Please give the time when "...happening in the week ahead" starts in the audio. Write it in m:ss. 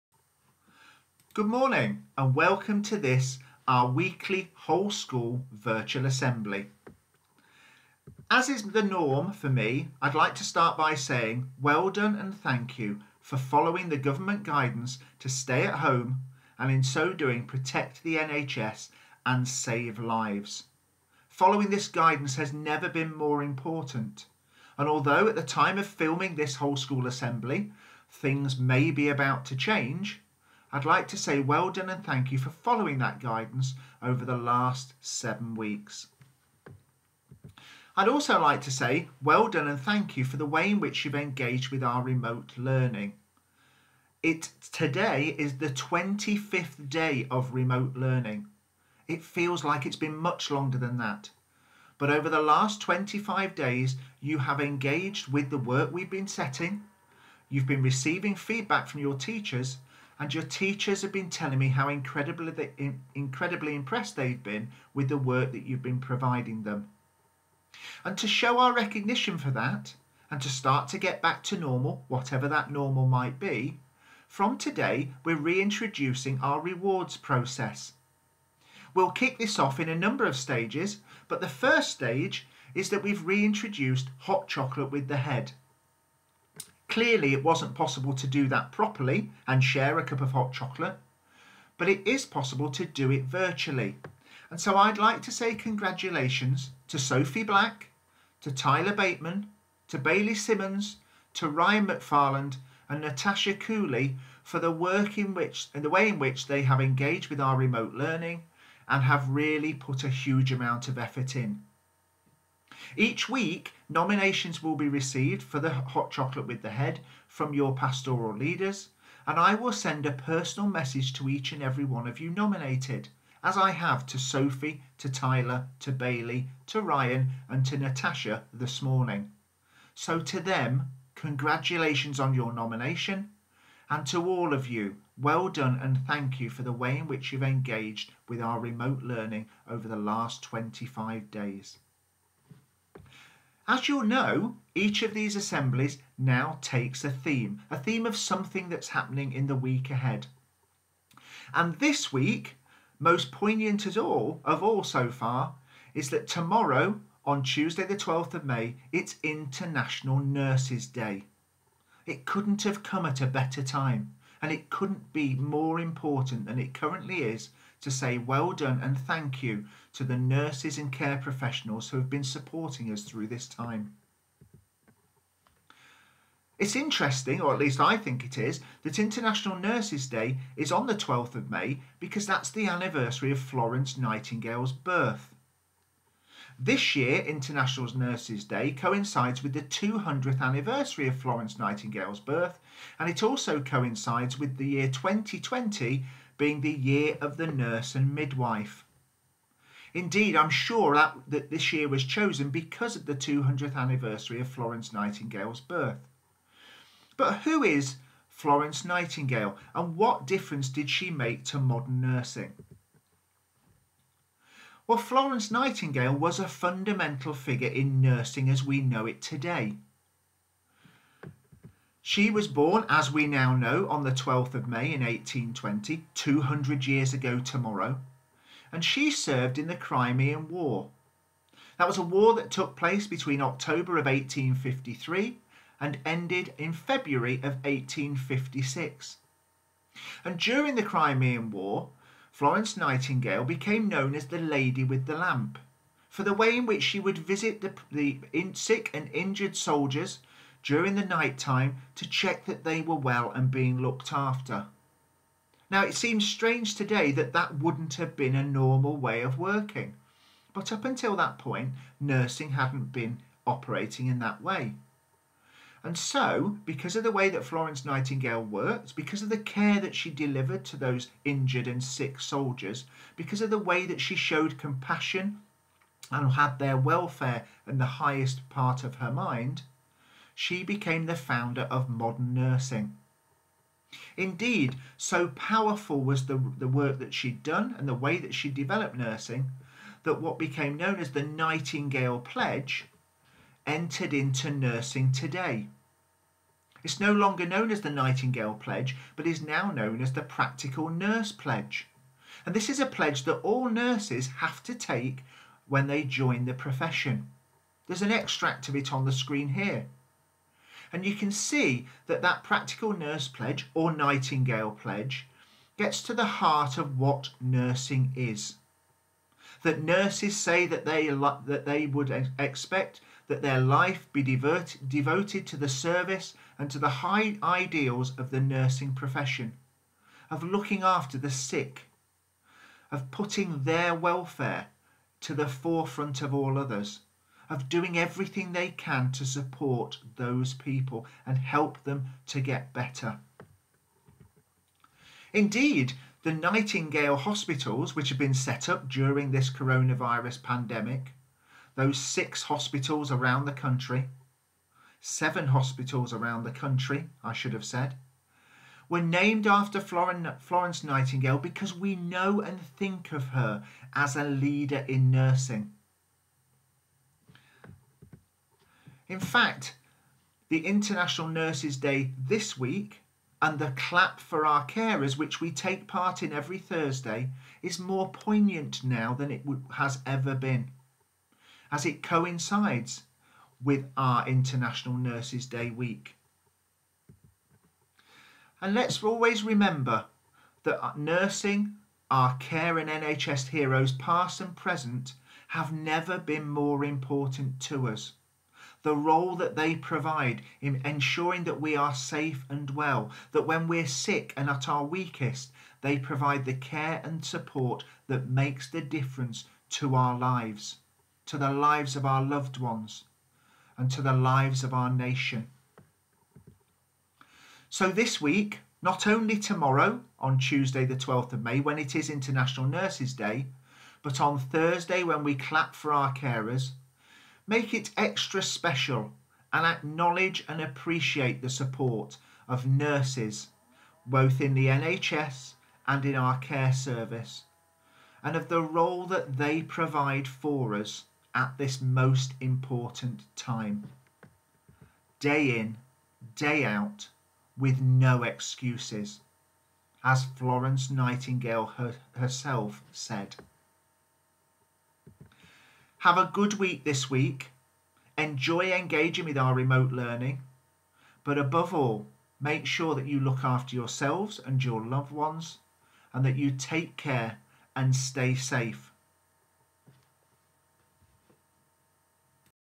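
2:28.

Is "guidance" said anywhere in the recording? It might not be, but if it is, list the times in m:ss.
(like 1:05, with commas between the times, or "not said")
0:14, 0:21, 0:33.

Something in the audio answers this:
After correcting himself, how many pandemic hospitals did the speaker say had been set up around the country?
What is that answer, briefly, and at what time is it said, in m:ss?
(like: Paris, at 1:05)
7, at 5:55.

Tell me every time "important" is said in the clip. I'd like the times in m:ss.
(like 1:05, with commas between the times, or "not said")
0:23, 2:45, 6:36, 7:22.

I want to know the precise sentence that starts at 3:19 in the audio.
Indeed, I'm sure that, that this year was chosen because of the 200th anniversary of Florence Nightingale's birth.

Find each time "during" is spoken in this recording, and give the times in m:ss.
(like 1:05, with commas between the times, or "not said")
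4:00, 4:10, 5:48.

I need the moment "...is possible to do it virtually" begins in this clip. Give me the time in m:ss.
1:32.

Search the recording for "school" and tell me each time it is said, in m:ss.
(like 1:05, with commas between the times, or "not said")
0:04, 0:26.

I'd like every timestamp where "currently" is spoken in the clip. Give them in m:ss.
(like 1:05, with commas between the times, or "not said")
2:46.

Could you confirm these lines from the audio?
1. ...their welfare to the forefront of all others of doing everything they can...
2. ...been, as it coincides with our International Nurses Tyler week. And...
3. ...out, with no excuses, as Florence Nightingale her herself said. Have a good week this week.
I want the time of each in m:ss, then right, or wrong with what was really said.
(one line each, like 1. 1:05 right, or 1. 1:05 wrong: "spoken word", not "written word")
1. 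5:33 right
2. 6:20 wrong: "Day", not "Tyler"
3. 7:26 right.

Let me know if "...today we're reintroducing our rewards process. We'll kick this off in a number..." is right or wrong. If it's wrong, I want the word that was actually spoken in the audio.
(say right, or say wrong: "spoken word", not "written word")
right.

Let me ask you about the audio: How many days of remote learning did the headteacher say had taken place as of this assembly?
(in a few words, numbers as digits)
25.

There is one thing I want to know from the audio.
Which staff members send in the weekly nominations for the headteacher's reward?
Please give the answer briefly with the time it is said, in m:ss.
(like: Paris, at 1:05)
Pastoral leaders, at 1:57.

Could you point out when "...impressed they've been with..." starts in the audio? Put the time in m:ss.
1:03.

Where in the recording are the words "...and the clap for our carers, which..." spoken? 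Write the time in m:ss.
6:13.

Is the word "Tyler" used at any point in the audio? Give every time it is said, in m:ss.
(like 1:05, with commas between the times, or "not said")
1:38, 2:05.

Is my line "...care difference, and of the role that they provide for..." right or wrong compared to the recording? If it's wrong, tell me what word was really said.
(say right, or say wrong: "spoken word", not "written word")
wrong: "service", not "difference".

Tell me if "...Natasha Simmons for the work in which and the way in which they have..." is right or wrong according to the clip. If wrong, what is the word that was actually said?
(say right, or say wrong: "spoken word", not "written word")
wrong: "Cooley", not "Simmons".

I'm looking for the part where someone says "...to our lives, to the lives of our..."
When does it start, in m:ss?
6:49.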